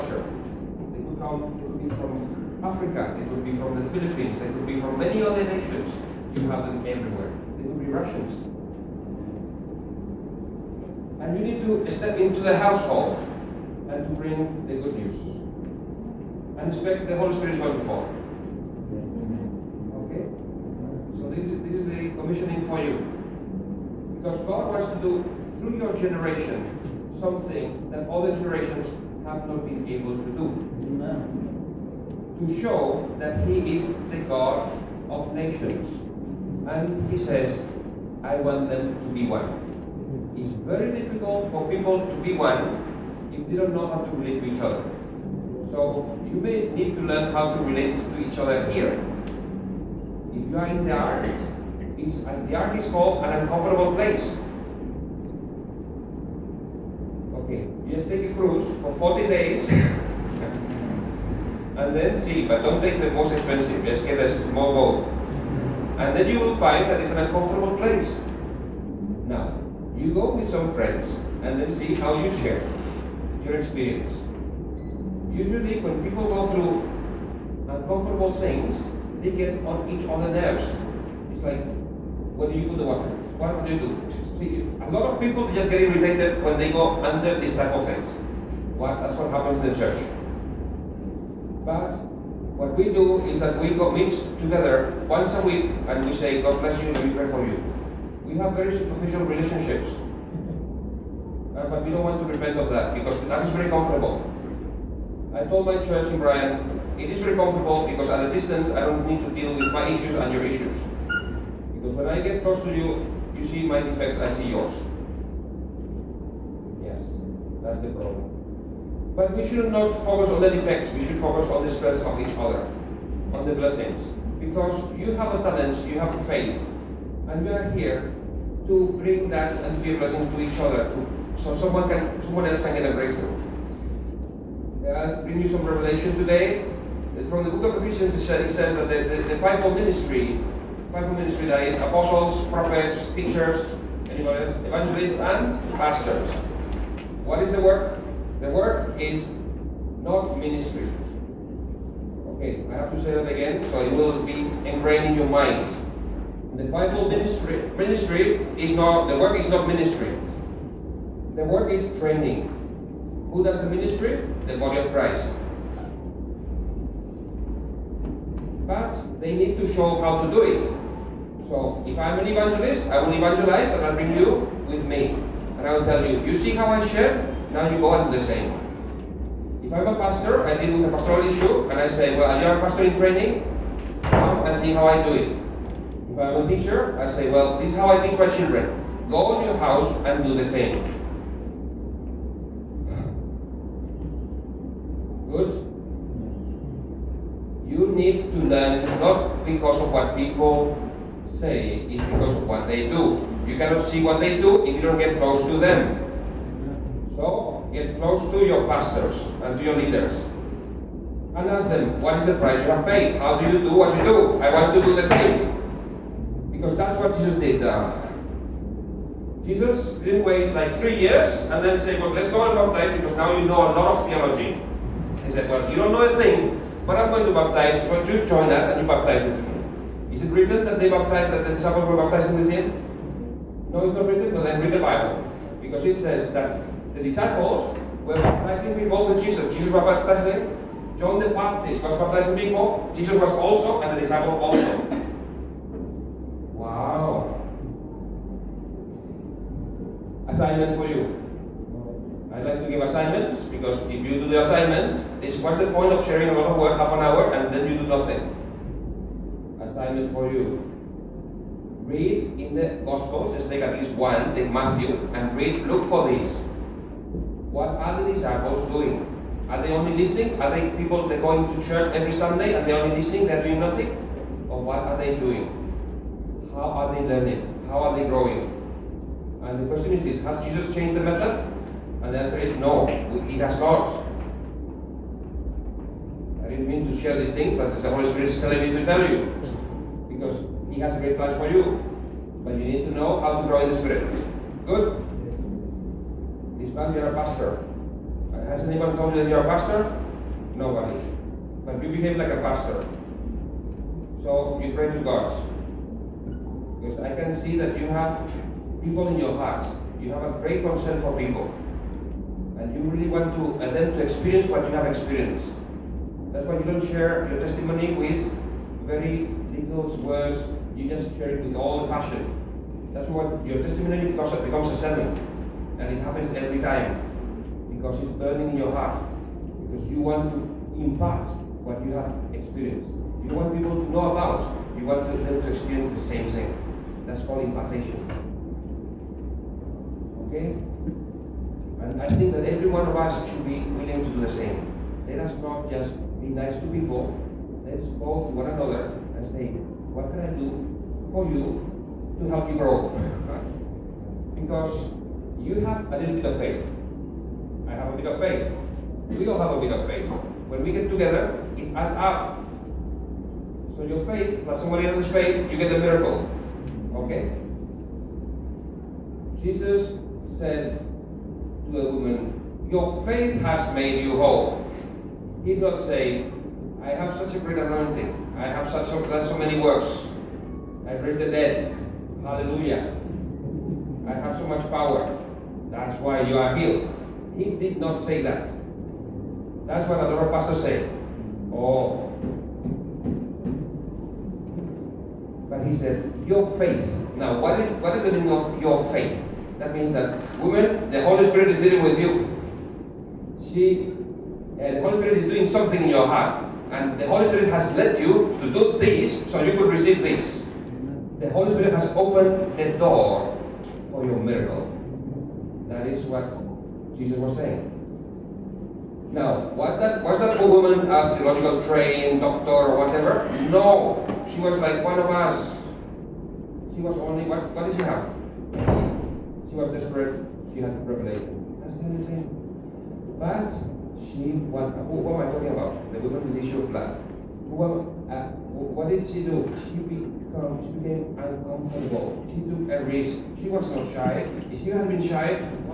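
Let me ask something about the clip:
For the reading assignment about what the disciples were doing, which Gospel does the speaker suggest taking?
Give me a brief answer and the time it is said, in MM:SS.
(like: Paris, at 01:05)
Matthew, at 04:24.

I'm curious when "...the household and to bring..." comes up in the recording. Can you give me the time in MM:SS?
00:12.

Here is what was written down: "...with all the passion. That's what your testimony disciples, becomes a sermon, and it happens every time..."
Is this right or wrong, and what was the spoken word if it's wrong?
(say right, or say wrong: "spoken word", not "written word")
wrong: "becomes", not "disciples".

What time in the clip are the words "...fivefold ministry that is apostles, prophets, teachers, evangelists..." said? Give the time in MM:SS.
02:20.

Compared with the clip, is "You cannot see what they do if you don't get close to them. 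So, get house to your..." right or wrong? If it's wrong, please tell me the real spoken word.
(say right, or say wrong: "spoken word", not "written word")
wrong: "close", not "house".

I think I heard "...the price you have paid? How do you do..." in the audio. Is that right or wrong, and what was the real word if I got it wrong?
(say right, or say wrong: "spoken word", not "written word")
right.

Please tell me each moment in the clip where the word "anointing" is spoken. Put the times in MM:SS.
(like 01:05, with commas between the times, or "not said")
06:17.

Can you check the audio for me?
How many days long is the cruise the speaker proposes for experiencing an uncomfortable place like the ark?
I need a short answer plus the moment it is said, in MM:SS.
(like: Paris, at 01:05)
40, at 00:58.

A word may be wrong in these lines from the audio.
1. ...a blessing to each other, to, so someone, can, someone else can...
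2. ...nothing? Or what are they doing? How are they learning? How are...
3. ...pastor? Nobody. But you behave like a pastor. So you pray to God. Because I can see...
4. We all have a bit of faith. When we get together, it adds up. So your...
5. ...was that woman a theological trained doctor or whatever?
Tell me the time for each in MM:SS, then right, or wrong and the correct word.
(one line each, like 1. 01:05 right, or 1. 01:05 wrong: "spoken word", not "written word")
1. 02:09 right
2. 04:33 right
3. 04:59 right
4. 05:59 right
5. 07:00 right.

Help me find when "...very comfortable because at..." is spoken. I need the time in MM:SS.
01:47.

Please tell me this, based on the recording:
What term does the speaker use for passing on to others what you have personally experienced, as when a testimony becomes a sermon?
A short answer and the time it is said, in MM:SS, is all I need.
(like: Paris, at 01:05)
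Impartation, at 05:37.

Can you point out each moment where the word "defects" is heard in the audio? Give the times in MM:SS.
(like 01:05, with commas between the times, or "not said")
01:53, 02:00.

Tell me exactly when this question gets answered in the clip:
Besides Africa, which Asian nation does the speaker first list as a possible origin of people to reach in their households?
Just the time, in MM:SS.
00:03.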